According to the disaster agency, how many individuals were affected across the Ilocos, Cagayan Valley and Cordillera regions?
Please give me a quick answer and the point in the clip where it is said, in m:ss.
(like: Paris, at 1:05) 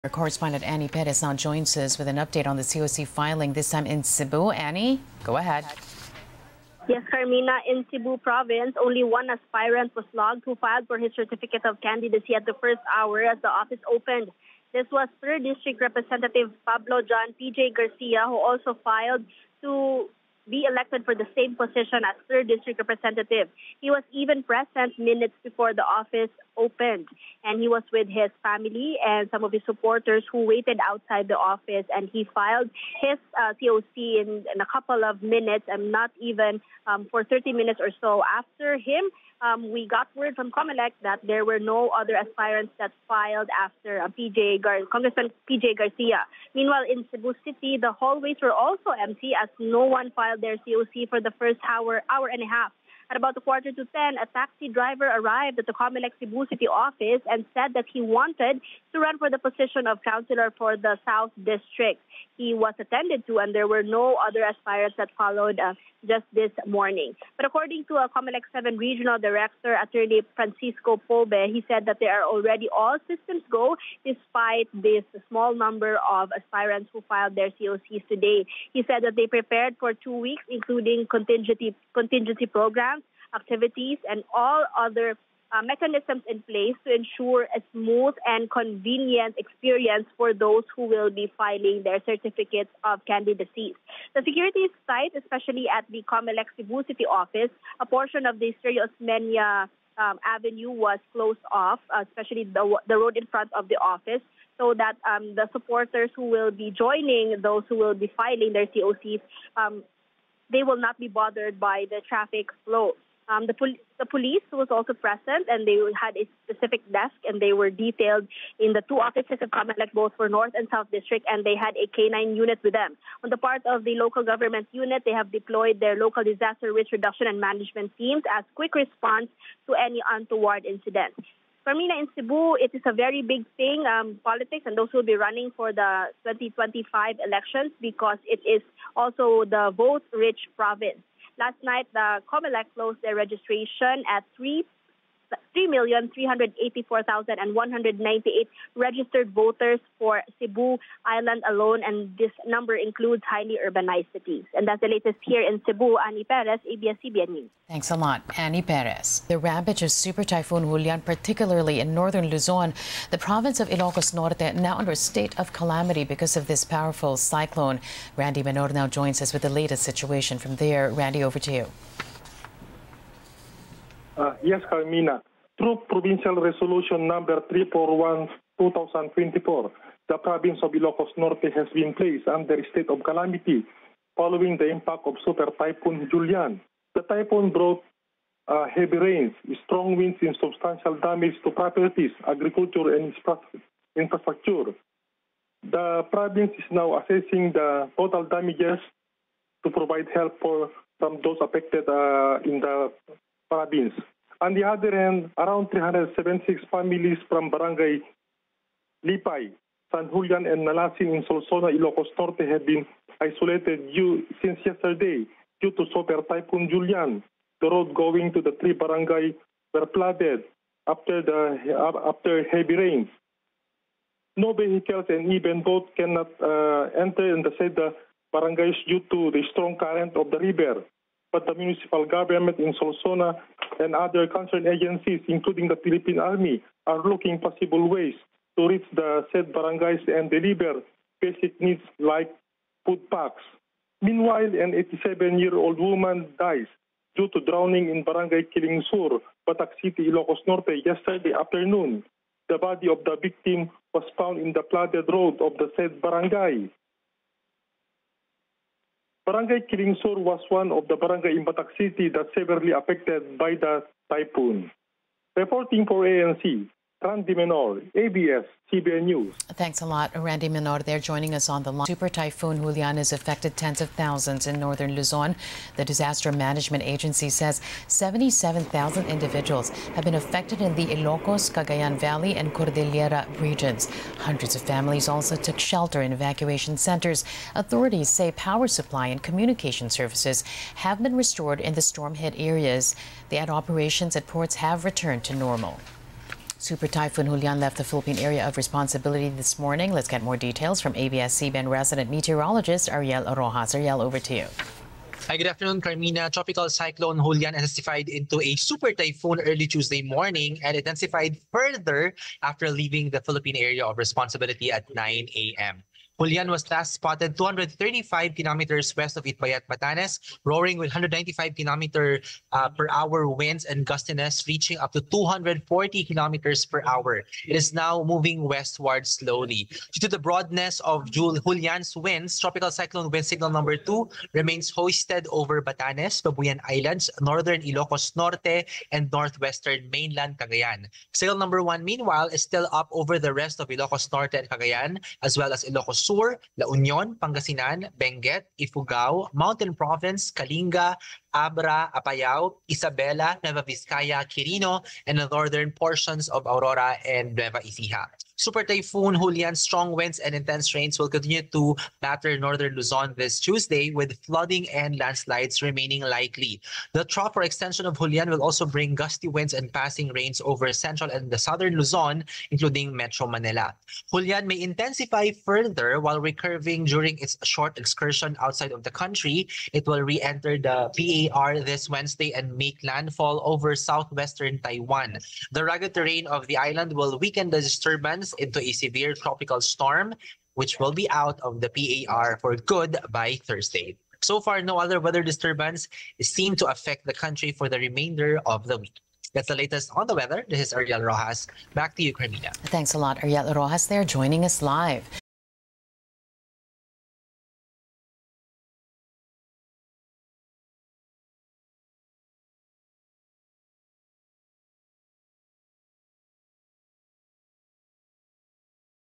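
77,000, at 4:37.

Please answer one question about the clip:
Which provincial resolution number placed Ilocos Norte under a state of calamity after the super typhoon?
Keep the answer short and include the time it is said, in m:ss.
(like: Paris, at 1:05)
341-2024, at 2:57.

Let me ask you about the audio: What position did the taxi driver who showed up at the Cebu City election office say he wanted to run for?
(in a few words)
Councilor.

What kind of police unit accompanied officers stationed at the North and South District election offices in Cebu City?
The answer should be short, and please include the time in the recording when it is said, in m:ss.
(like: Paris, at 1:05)
K-9 unit, at 2:01.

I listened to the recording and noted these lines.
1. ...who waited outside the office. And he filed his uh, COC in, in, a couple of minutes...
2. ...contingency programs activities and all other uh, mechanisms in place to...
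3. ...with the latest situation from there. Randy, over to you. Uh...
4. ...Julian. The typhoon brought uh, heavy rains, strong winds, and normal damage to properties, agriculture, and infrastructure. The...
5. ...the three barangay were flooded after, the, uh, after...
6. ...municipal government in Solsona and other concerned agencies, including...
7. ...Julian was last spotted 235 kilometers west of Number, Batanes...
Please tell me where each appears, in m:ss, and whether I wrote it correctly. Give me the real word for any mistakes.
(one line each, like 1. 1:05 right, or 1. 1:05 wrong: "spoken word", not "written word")
1. 0:30 right
2. 1:21 right
3. 2:49 right
4. 3:06 wrong: "substantial", not "normal"
5. 3:38 right
6. 3:51 right
7. 5:16 wrong: "Itbayat", not "Number".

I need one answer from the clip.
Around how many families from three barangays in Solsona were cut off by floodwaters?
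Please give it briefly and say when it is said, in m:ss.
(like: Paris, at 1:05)
376, at 3:25.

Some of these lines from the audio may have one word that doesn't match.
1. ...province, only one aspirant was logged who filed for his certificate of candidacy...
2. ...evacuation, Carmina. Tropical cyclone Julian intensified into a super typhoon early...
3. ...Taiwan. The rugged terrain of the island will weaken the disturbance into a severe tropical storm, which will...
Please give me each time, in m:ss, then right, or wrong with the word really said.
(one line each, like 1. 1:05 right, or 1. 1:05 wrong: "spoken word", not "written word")
1. 0:08 right
2. 5:05 wrong: "afternoon", not "evacuation"
3. 6:24 right.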